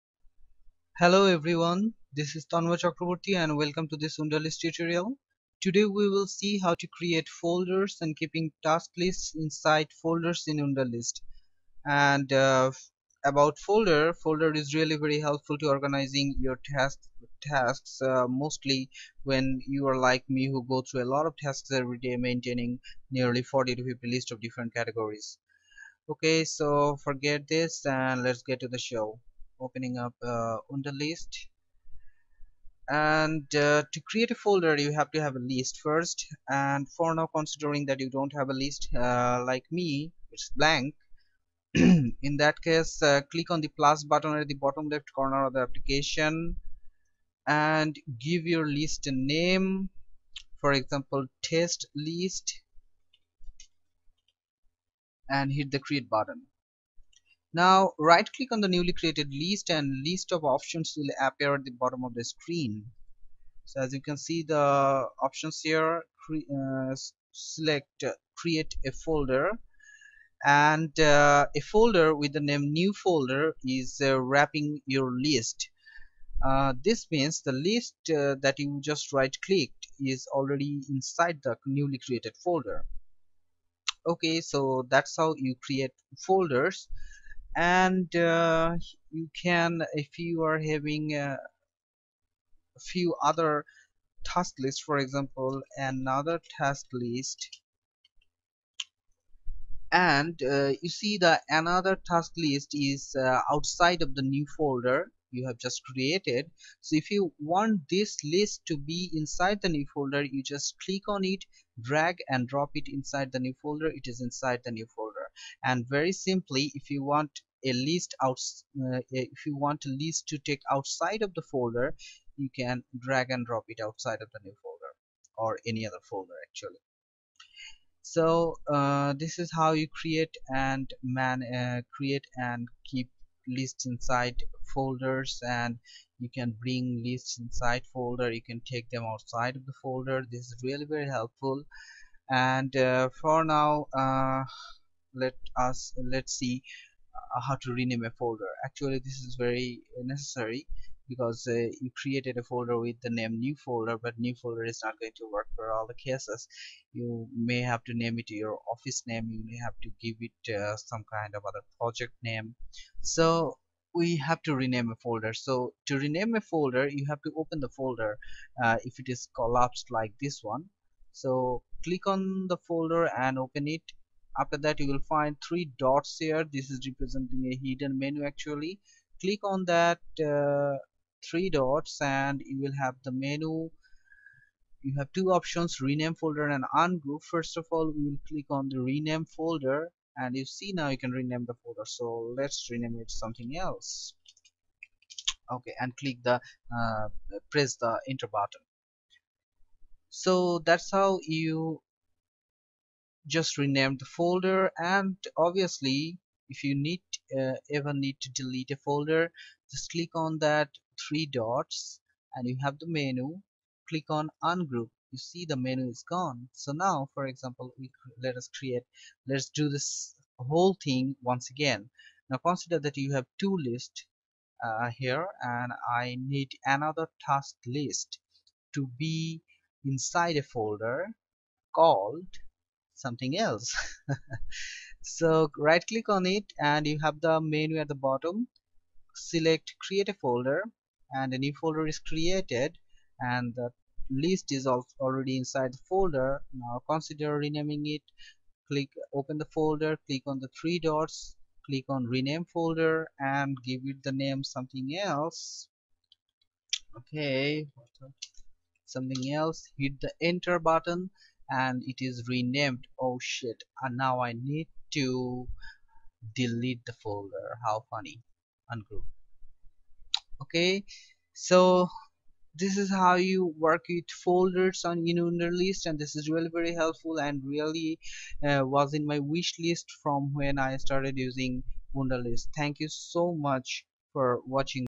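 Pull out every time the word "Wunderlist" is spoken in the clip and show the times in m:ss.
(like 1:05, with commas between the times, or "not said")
0:04, 0:10, 4:34, 4:41.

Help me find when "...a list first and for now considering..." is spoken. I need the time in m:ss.
0:35.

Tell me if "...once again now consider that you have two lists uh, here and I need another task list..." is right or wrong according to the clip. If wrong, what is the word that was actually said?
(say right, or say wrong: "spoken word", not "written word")
right.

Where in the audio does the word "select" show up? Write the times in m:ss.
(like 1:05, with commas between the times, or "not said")
1:07, 3:59.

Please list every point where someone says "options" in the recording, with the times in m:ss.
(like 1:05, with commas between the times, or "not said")
1:00, 1:05, 3:05.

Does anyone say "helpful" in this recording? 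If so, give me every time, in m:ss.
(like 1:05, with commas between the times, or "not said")
0:15, 2:21, 4:36.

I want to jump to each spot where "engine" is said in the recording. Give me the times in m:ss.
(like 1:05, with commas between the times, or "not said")
not said.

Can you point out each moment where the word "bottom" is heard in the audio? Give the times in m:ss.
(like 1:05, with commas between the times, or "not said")
0:44, 1:01, 3:58.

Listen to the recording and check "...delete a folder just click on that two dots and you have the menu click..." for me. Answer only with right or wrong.
wrong.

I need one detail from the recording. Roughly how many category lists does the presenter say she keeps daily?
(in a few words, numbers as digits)
40 to 50.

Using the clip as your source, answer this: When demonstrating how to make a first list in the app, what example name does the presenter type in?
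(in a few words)
test list.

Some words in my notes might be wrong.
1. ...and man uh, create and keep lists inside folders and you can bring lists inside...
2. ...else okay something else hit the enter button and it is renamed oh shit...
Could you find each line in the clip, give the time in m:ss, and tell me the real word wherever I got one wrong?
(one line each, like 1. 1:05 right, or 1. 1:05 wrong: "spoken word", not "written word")
1. 2:10 right
2. 4:15 right.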